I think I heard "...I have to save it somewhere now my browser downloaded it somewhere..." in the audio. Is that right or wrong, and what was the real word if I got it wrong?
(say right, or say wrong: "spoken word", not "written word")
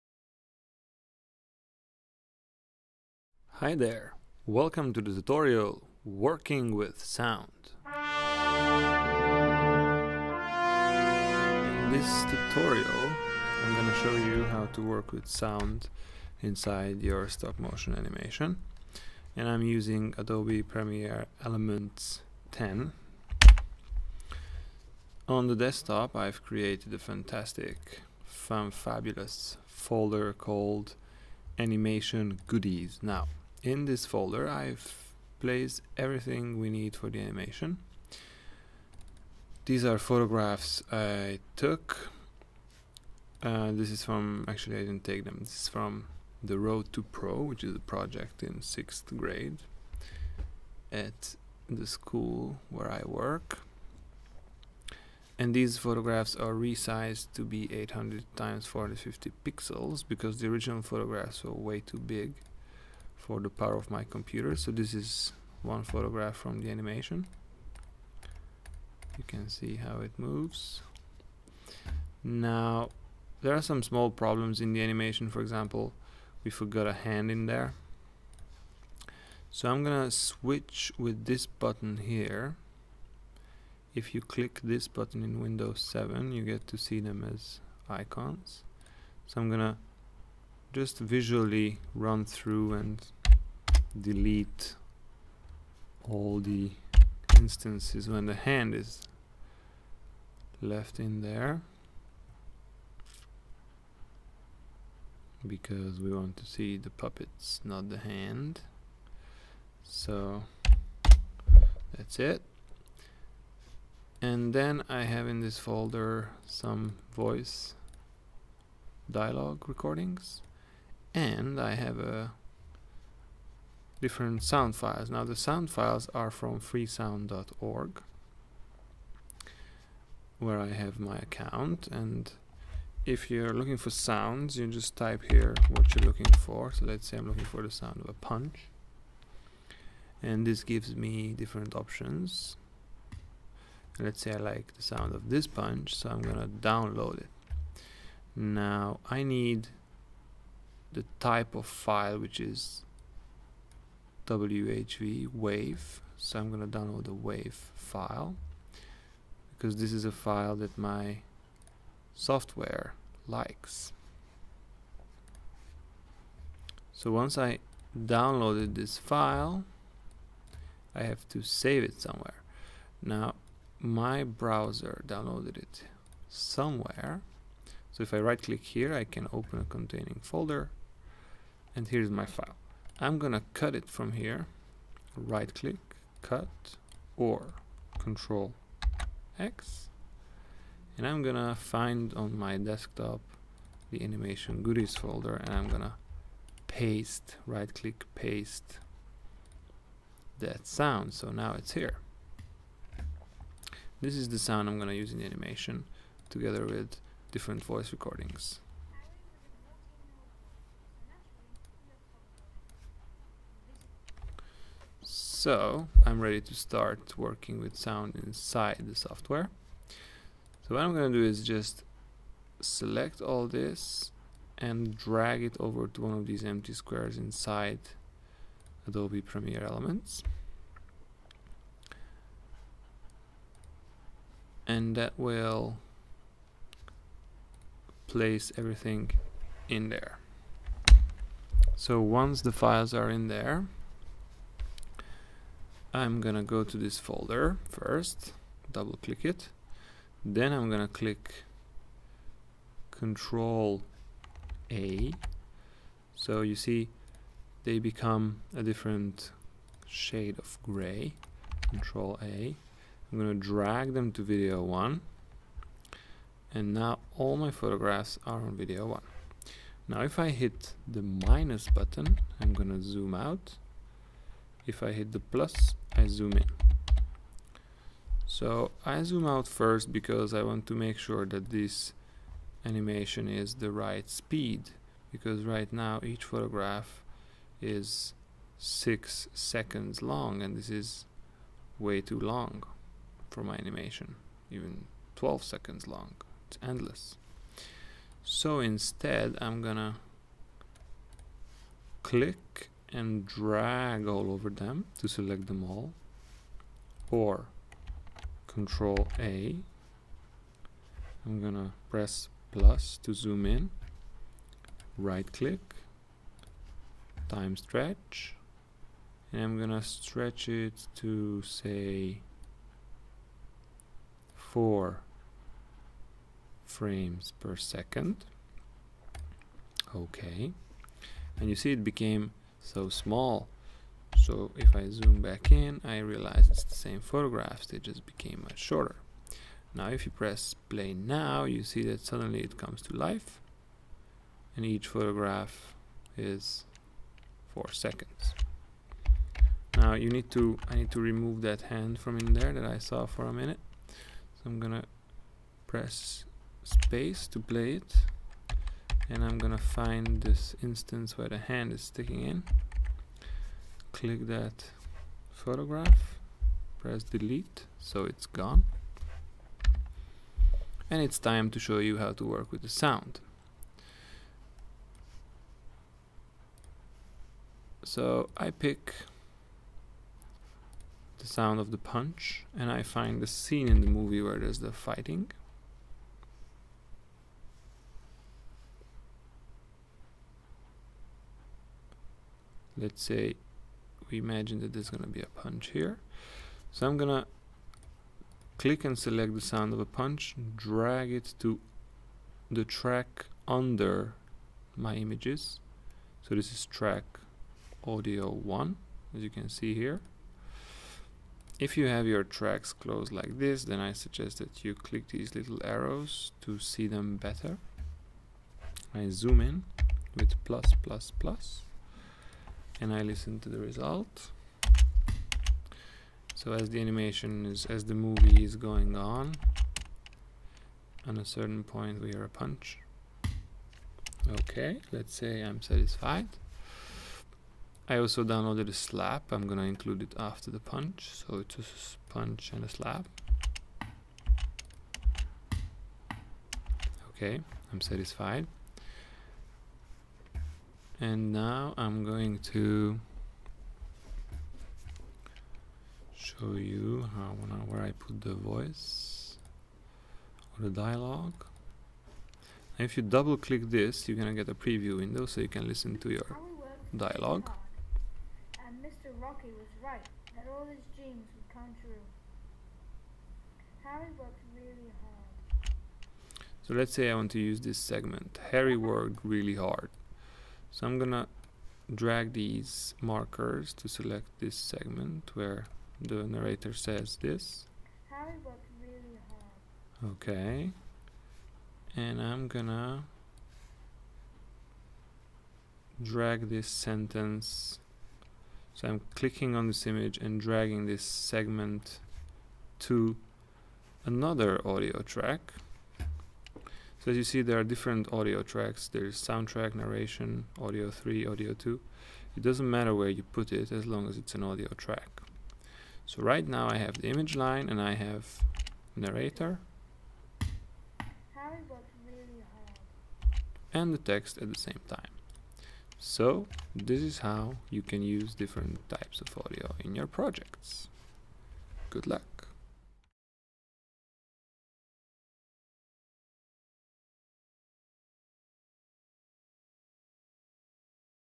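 right.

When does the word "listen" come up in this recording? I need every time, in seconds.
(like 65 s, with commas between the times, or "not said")
423 s, 465 s.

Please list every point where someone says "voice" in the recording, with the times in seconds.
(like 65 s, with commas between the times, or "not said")
117 s, 207 s, 458 s.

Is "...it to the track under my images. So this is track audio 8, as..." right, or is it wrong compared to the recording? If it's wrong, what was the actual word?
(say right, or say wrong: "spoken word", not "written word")
wrong: "1", not "8".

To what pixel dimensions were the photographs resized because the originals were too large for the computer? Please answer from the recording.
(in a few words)
800 x 450.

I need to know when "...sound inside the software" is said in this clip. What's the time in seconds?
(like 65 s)
217 s.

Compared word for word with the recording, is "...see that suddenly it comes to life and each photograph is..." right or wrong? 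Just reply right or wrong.
right.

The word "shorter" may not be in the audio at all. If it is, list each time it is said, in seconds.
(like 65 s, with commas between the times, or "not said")
338 s.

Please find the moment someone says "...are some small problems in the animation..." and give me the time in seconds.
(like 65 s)
73 s.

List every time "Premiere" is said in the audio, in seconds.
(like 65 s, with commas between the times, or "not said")
20 s, 229 s.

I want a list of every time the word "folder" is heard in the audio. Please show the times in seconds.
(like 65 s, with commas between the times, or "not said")
29 s, 34 s, 115 s, 180 s, 194 s, 246 s.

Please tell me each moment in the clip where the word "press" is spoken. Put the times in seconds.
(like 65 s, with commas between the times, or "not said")
311 s, 340 s, 355 s, 366 s.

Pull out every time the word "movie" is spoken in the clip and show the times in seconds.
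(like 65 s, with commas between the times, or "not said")
383 s, 427 s.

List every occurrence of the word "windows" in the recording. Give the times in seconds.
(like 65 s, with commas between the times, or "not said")
85 s, 464 s.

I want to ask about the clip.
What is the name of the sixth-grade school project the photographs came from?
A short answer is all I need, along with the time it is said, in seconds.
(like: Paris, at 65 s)
Road to Pro, at 46 s.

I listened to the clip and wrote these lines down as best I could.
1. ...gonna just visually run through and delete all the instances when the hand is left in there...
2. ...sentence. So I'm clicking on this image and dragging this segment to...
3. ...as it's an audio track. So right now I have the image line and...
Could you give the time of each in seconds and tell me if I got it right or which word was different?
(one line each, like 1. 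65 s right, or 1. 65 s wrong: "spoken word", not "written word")
1. 89 s right
2. 496 s right
3. 514 s right.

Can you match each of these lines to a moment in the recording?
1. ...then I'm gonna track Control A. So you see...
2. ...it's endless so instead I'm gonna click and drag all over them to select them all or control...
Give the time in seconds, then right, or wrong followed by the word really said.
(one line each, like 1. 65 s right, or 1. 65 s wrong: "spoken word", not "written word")
1. 250 s wrong: "click", not "track"
2. 296 s right.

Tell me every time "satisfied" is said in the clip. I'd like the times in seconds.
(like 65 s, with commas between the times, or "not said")
435 s, 447 s.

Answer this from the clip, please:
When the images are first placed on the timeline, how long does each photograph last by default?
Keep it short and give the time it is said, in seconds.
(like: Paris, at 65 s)
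6 seconds, at 288 s.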